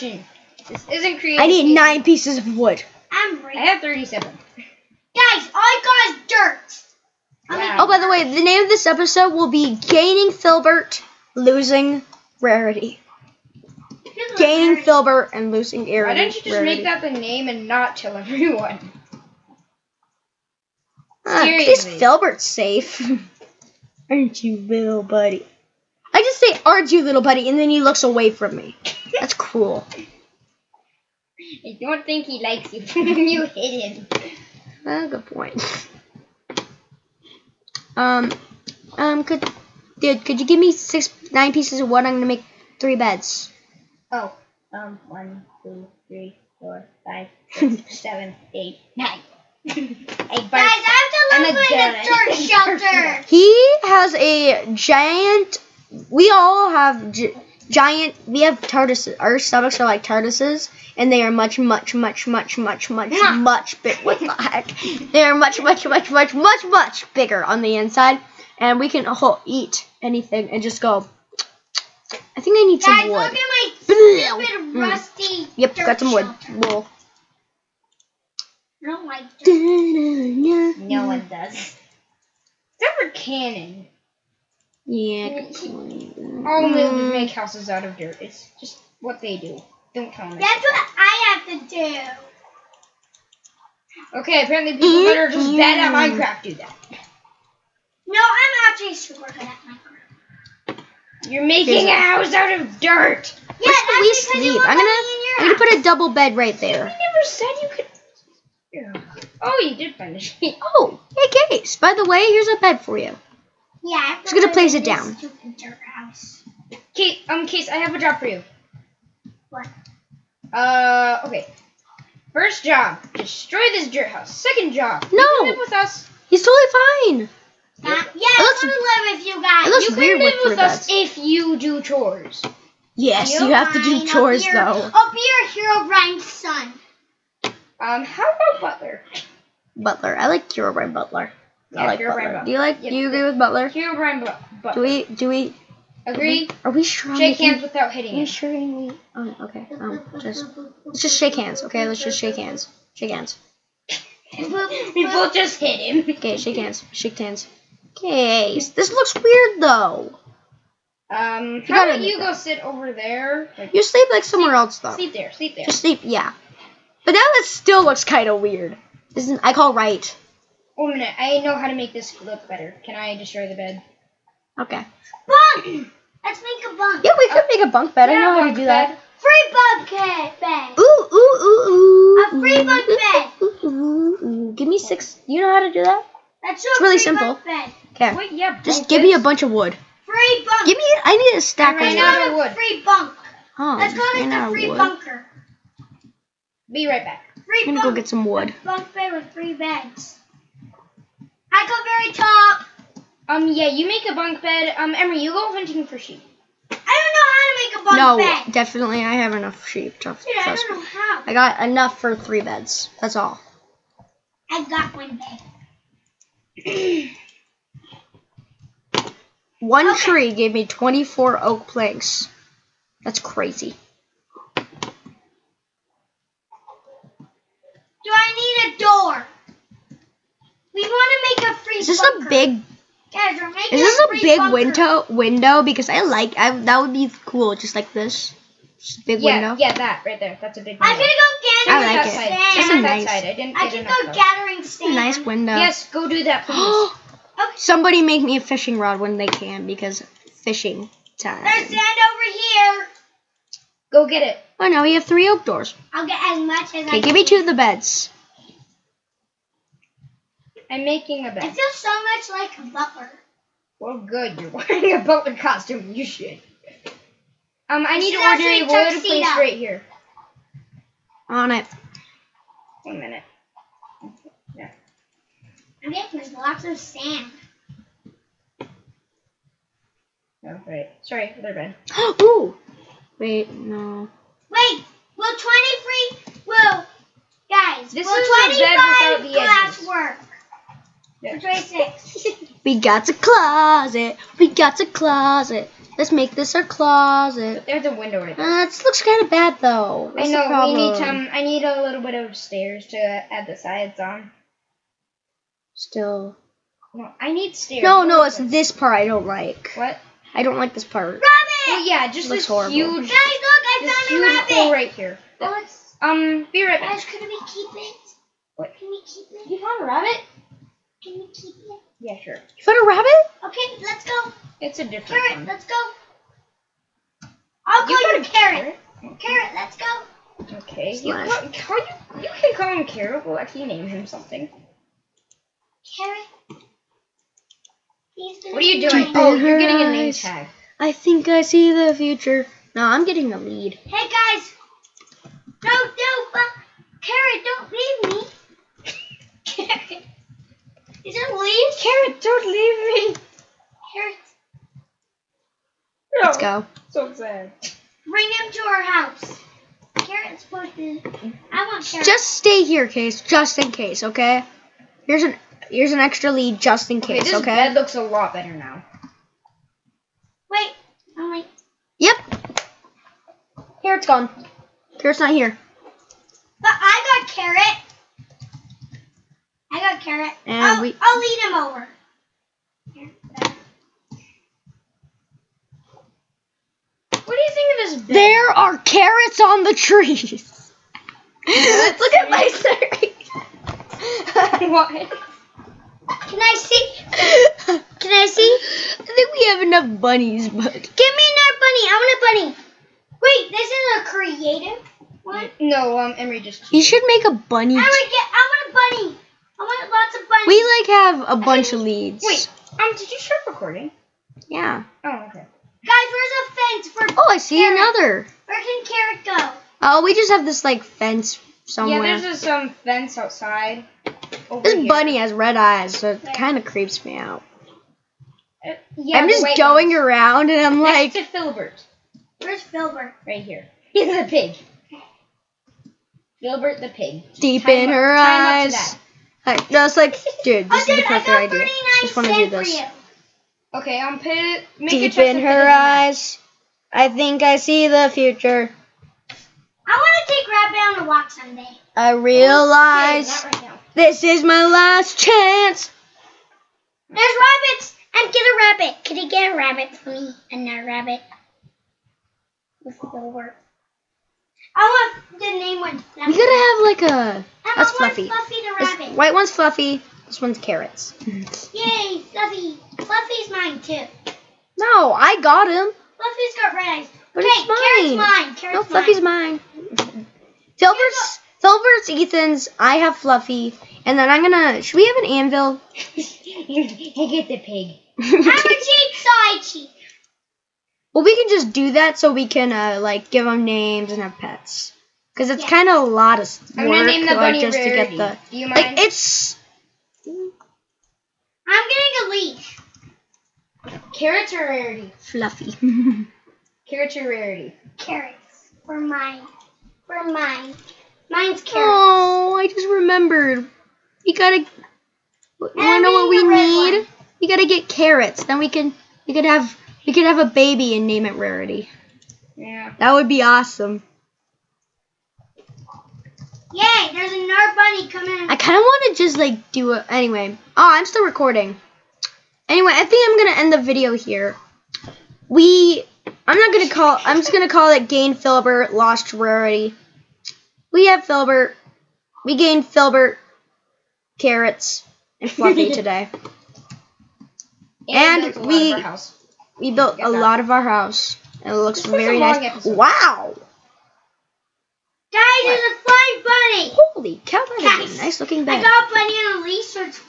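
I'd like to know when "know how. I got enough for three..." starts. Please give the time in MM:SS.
03:30.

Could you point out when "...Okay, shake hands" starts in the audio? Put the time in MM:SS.
02:36.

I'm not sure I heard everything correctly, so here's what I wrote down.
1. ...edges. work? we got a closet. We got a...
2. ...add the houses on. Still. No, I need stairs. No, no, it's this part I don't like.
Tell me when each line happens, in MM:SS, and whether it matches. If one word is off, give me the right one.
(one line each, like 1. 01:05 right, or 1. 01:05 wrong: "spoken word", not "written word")
1. 04:49 right
2. 05:02 wrong: "sides", not "houses".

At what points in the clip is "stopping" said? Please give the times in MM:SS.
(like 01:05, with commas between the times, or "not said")
not said.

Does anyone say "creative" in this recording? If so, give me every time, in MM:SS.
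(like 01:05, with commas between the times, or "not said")
00:01, 06:44.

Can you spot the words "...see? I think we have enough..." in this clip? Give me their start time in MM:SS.
06:38.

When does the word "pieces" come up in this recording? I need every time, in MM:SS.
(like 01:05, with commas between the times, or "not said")
00:02, 00:41.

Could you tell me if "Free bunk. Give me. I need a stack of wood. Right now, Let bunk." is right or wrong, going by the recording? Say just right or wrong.
wrong.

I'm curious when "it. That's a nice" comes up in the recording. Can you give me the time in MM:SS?
04:02.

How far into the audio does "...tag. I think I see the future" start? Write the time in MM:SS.
05:40.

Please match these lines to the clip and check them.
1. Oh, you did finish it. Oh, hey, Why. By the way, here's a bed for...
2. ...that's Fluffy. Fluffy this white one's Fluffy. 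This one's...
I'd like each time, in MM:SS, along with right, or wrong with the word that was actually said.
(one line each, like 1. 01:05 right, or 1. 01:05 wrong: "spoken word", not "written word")
1. 01:49 wrong: "Case", not "Why"
2. 07:47 right.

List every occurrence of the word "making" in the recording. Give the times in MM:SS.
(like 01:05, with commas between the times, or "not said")
01:41, 03:53, 04:20.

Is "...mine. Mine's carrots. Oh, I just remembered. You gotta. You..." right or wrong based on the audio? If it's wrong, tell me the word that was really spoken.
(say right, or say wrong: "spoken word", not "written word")
right.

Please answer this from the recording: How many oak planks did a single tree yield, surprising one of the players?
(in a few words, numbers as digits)
24.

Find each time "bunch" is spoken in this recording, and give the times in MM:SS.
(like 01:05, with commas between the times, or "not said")
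03:09, 06:51.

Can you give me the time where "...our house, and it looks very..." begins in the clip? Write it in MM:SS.
09:10.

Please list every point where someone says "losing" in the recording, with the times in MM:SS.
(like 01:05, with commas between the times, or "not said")
00:11, 00:15.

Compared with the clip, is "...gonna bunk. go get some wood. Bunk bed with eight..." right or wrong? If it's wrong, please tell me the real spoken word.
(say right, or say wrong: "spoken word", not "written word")
wrong: "three", not "eight".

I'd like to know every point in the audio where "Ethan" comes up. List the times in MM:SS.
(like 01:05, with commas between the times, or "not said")
08:02.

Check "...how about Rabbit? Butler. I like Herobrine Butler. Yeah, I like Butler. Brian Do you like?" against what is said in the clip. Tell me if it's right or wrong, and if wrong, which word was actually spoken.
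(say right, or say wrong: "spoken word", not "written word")
wrong: "Butler", not "Rabbit".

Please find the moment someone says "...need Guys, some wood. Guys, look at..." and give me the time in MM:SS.
01:12.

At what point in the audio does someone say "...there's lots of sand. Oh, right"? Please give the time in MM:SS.
04:36.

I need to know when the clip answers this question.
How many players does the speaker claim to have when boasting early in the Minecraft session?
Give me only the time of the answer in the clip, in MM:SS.
00:03.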